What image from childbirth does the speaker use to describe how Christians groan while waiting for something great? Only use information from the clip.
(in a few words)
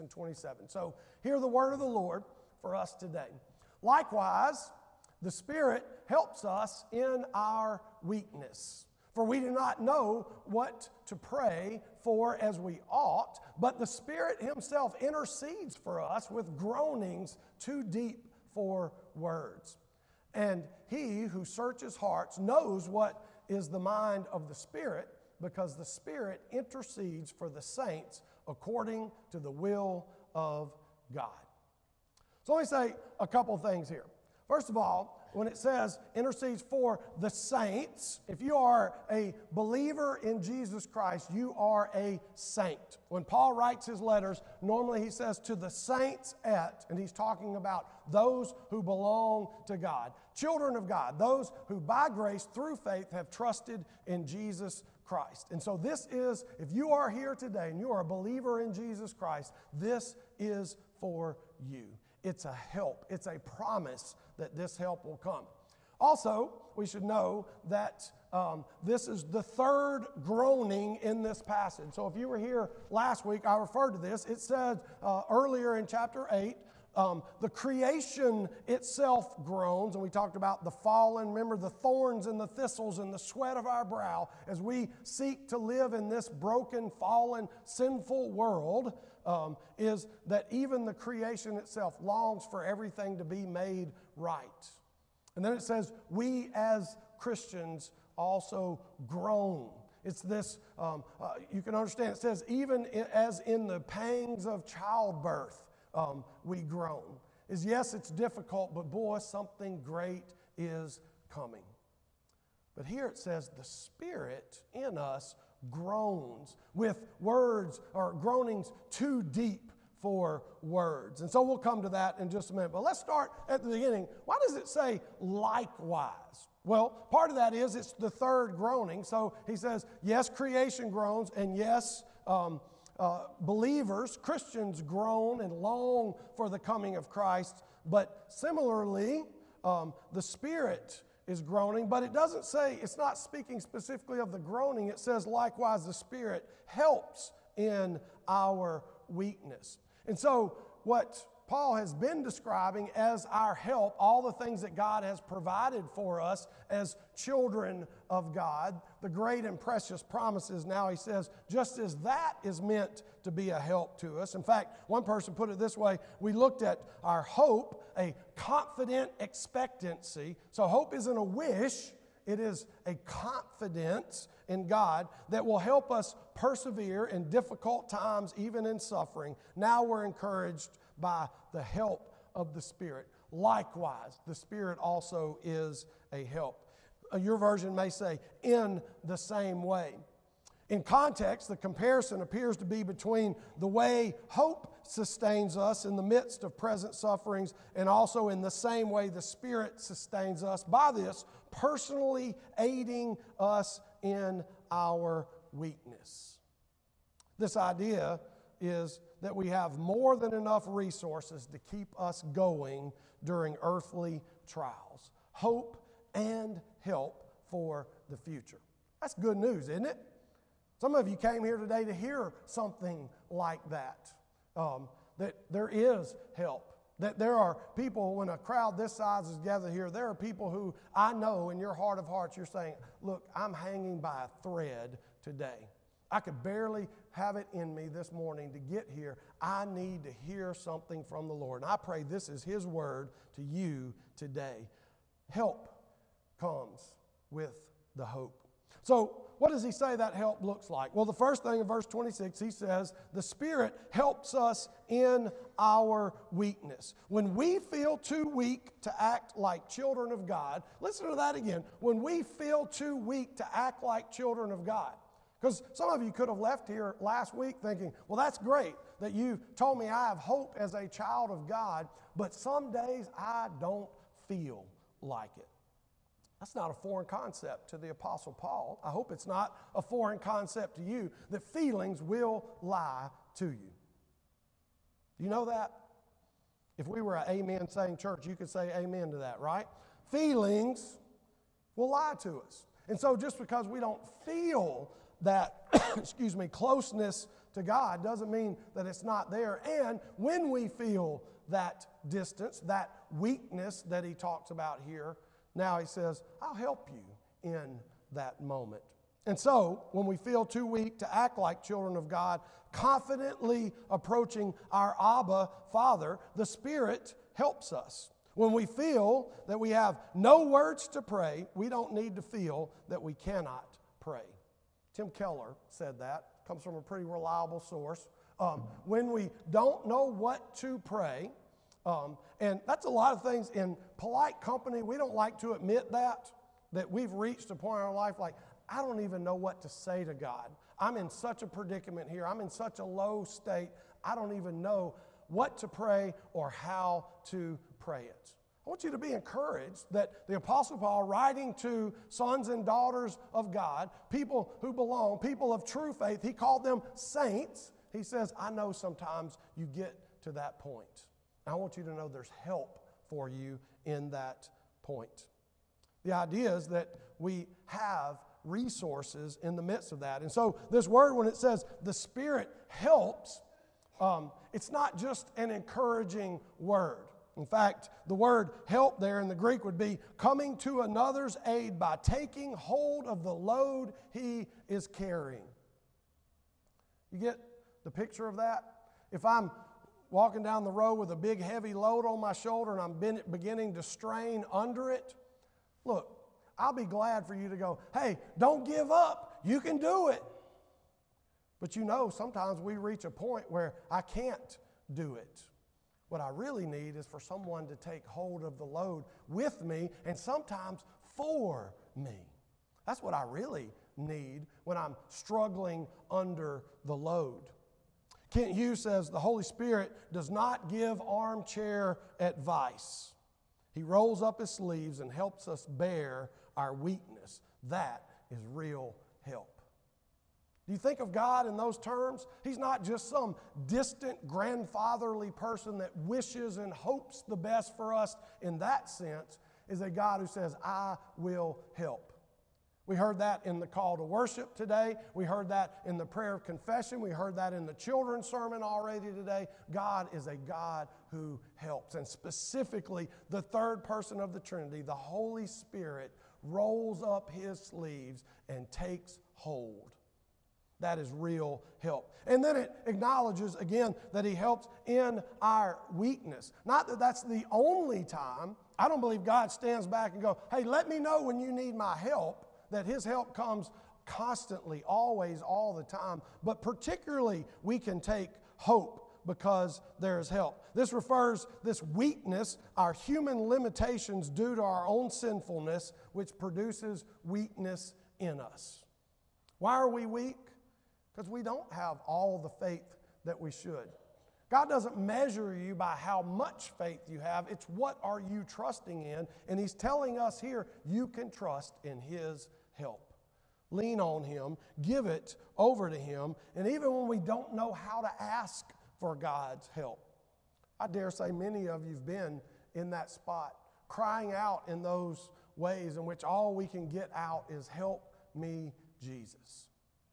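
pangs of childbirth.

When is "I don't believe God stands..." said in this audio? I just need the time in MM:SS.
07:48.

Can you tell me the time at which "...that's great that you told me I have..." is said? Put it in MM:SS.
04:28.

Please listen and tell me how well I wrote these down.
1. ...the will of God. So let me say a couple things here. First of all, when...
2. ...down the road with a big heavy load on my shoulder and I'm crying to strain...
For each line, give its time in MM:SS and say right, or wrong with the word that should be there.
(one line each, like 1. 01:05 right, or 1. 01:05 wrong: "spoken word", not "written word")
1. 00:29 right
2. 06:30 wrong: "beginning", not "crying".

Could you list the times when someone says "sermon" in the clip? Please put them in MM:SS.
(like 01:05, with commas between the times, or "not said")
07:28.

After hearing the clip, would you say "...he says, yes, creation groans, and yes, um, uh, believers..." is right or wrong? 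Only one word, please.
right.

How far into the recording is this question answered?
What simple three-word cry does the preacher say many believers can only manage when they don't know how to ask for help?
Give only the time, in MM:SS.
08:37.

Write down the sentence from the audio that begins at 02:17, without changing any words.
But similarly, um, the Spirit is groaning, but it doesn't say, it's not speaking specifically of the groaning.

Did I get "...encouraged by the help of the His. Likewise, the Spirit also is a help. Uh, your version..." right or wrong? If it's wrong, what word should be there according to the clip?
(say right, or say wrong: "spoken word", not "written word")
wrong: "Spirit", not "His".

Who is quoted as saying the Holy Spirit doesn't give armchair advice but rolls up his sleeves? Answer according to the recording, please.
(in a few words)
Kent Hughes.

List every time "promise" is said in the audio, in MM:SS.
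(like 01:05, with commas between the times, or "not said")
01:03, 02:40.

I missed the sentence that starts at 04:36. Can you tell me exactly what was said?
That's not a foreign concept to the Apostle Paul.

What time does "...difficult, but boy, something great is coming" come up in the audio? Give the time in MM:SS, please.
01:48.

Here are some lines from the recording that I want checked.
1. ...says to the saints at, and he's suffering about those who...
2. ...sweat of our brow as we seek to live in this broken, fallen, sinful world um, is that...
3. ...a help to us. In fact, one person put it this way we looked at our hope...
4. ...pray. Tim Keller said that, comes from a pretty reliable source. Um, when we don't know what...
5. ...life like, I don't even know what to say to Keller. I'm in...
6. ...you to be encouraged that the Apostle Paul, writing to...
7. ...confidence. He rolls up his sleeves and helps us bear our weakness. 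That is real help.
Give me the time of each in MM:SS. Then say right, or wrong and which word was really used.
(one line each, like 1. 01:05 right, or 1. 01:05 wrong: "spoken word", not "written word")
1. 00:45 wrong: "talking", not "suffering"
2. 01:23 right
3. 02:43 right
4. 05:23 right
5. 05:37 wrong: "God", not "Keller"
6. 05:48 right
7. 07:02 wrong: "advice", not "confidence".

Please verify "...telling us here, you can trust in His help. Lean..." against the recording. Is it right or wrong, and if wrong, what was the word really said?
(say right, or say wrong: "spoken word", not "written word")
right.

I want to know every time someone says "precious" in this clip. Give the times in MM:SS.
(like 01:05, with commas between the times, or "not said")
02:39.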